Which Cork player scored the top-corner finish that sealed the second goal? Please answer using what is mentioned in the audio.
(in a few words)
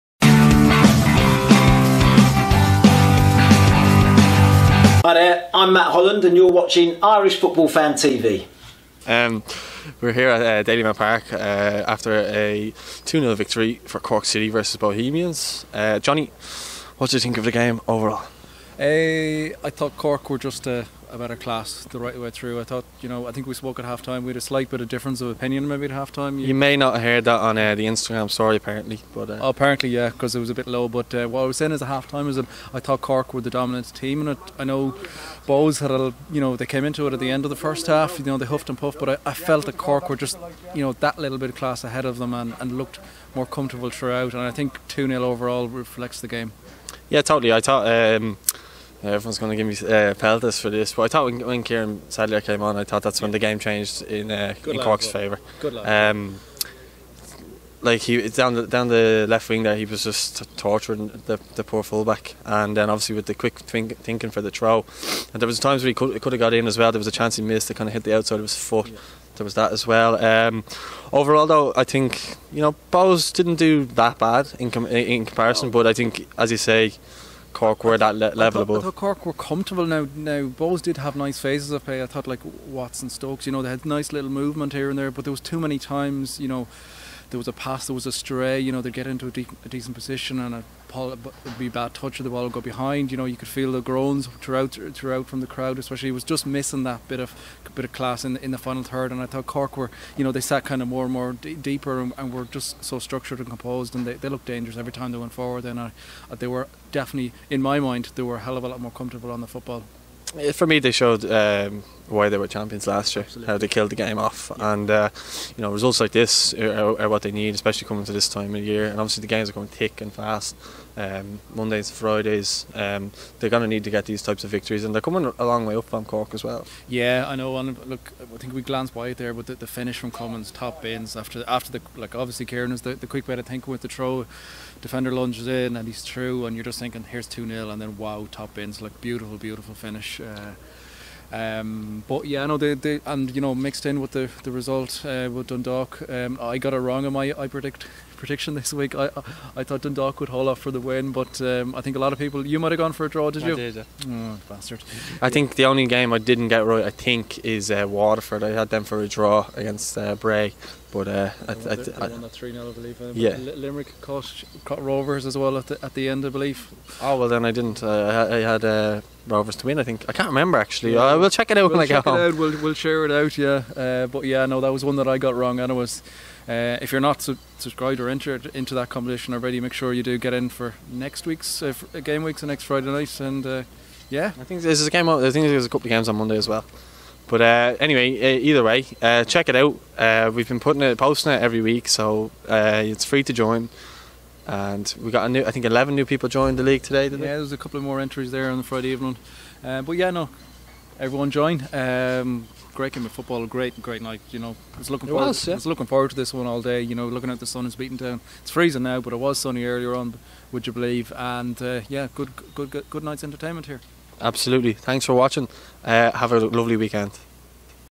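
Cummins.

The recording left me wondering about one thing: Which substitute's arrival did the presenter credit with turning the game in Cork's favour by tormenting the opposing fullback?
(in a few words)
Kieran Sadlier.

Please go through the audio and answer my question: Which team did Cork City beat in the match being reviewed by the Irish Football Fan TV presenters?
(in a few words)
Bohemians.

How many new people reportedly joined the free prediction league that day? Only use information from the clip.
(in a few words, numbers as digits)
11.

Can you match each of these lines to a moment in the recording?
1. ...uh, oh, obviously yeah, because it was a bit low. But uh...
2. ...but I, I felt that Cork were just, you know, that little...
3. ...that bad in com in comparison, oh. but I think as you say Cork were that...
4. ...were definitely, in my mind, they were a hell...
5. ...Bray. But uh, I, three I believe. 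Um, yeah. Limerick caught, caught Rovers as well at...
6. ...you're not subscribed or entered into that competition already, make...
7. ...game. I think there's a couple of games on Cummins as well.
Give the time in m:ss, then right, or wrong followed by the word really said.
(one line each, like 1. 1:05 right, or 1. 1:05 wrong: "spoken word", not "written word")
1. 0:29 wrong: "apparently", not "obviously"
2. 0:38 right
3. 1:13 right
4. 1:46 right
5. 2:40 right
6. 2:56 right
7. 3:04 wrong: "Monday", not "Cummins".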